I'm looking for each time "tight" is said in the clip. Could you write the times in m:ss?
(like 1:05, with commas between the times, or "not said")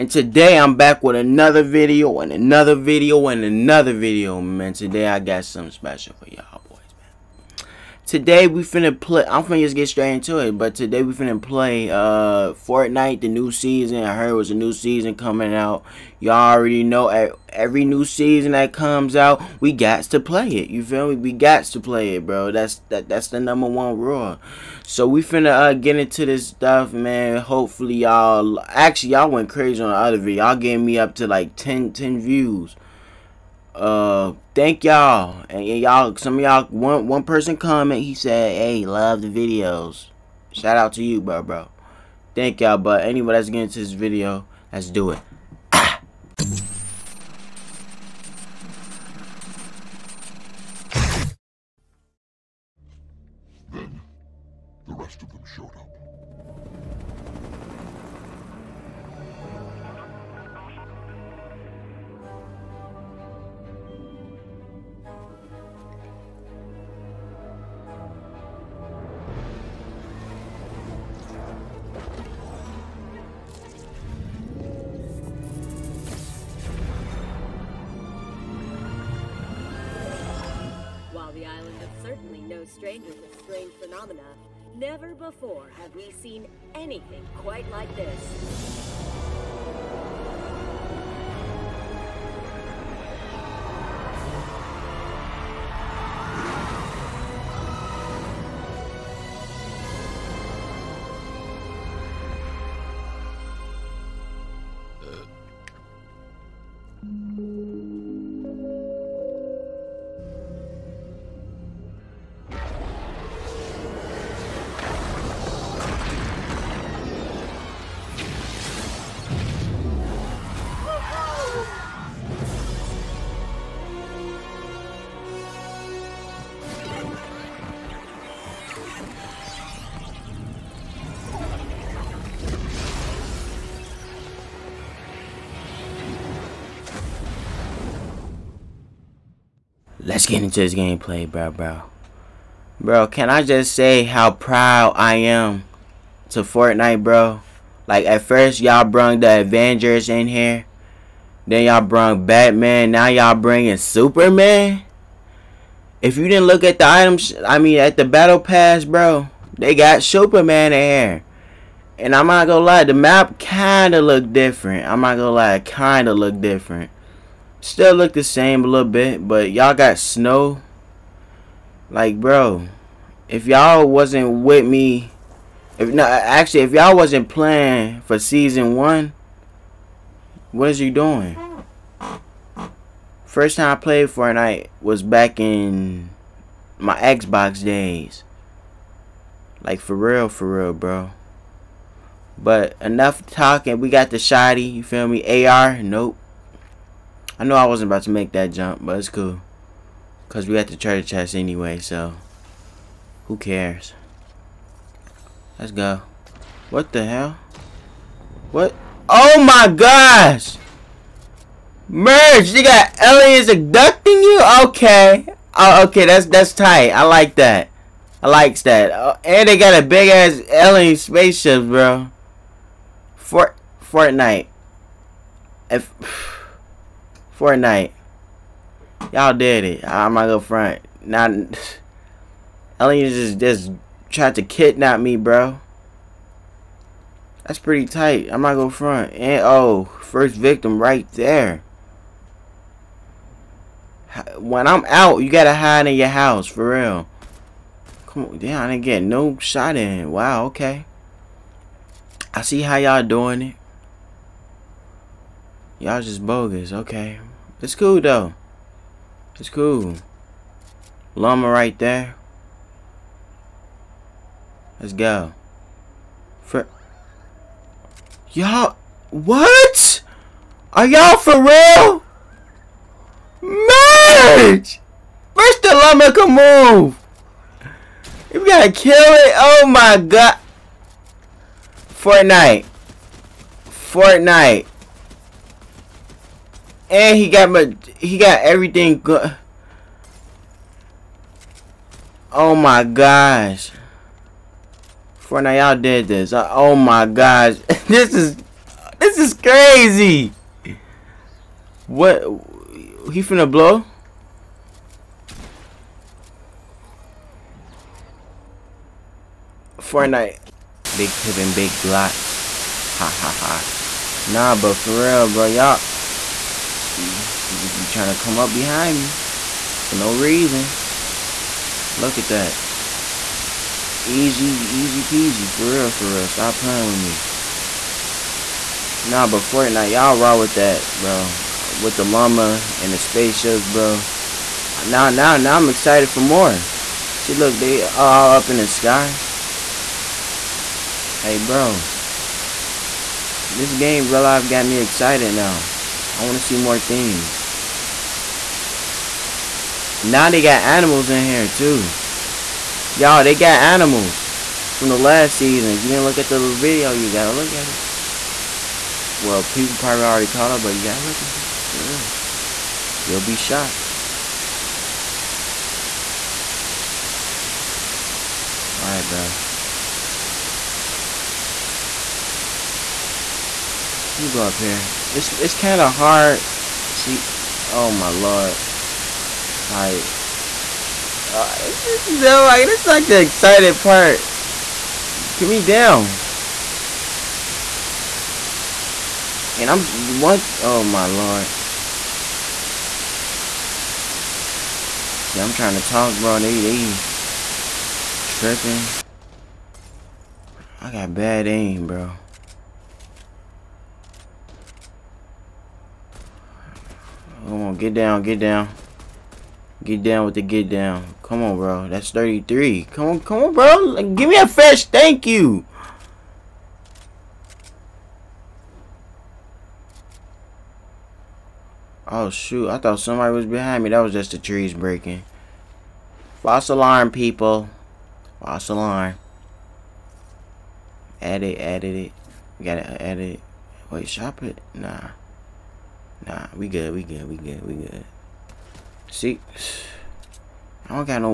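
3:36, 3:57.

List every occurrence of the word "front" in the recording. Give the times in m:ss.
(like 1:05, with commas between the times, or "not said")
3:50, 3:58.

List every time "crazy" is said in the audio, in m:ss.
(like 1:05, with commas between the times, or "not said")
0:29, 4:59.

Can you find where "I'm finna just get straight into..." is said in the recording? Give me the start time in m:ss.
0:09.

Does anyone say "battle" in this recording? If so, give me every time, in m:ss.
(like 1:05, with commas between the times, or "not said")
2:38.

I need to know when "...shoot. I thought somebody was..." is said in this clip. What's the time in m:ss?
7:02.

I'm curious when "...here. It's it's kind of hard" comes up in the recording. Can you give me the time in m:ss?
6:14.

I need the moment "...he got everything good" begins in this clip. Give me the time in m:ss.
4:47.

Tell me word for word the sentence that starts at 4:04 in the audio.
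When I'm out, you gotta hide in your house for real.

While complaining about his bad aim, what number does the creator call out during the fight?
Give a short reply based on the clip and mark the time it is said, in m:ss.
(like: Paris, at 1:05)
33, at 6:52.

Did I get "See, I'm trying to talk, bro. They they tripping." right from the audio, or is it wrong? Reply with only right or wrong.
right.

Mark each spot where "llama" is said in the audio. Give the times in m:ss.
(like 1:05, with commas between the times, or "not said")
4:21, 4:35, 5:32.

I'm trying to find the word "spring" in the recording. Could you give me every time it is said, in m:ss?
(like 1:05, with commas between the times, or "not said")
not said.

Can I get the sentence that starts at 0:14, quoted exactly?
I heard it was a new season coming out.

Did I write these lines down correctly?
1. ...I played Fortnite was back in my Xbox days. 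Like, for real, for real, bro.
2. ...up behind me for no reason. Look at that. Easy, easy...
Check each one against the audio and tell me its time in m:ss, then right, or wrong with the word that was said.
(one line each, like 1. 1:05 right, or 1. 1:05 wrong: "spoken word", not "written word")
1. 3:03 right
2. 5:18 right.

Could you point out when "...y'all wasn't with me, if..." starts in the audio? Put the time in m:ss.
2:53.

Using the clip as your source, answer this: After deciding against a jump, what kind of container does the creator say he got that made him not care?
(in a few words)
treasure chest.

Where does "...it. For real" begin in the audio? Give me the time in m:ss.
6:01.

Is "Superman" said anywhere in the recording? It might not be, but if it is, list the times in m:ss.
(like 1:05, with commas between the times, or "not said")
2:33, 2:40.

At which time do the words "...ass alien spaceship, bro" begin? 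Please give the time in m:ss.
3:40.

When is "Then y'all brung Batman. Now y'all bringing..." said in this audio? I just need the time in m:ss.
2:31.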